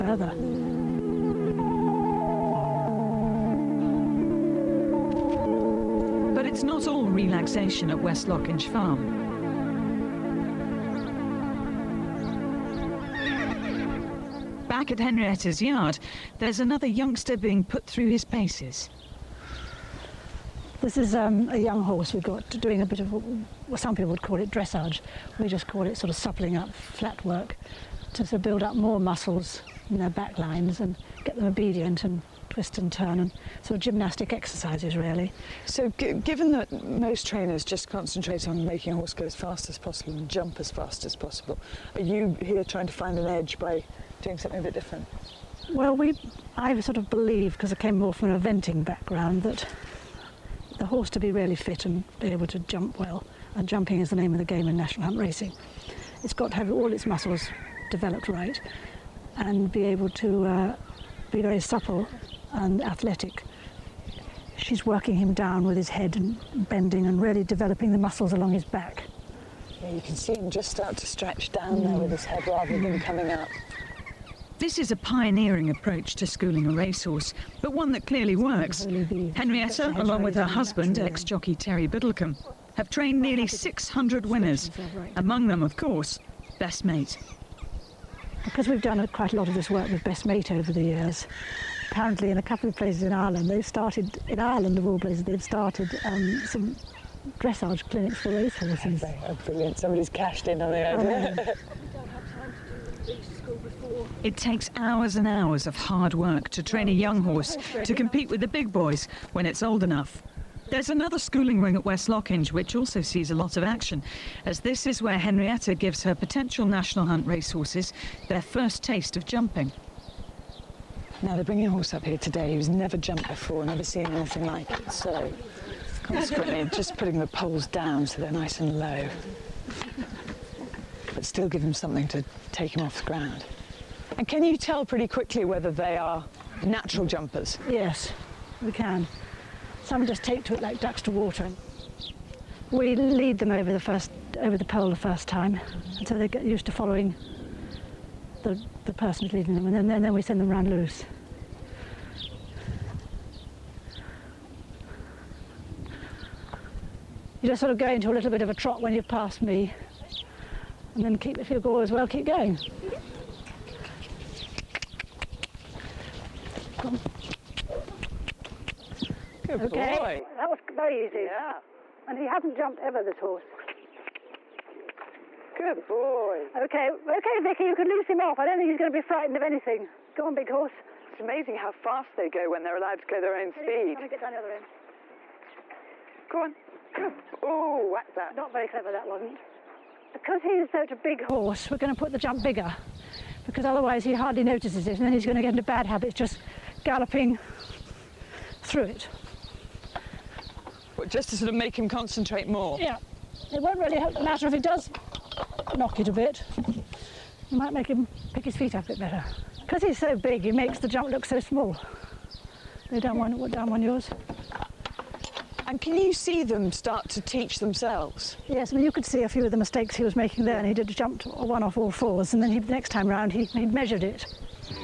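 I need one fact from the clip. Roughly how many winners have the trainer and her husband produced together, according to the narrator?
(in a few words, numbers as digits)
600.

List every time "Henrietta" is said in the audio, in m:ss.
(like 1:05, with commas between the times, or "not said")
0:15, 1:19, 1:55.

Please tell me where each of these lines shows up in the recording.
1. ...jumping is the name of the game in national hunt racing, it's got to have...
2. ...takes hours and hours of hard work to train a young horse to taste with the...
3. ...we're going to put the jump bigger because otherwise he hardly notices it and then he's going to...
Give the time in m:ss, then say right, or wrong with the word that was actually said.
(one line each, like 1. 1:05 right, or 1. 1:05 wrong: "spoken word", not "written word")
1. 0:53 right
2. 1:44 wrong: "compete", not "taste"
3. 3:11 right.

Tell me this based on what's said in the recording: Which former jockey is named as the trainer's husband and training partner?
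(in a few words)
Terry Biddlecombe.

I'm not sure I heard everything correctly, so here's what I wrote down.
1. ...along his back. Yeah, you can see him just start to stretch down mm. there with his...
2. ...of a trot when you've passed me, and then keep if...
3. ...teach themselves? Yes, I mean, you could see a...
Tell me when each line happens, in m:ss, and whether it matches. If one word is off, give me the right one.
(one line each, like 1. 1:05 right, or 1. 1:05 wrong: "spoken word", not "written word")
1. 1:08 right
2. 2:38 right
3. 3:37 right.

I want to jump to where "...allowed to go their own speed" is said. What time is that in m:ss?
3:02.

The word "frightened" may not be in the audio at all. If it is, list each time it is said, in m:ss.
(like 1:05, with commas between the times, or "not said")
2:59.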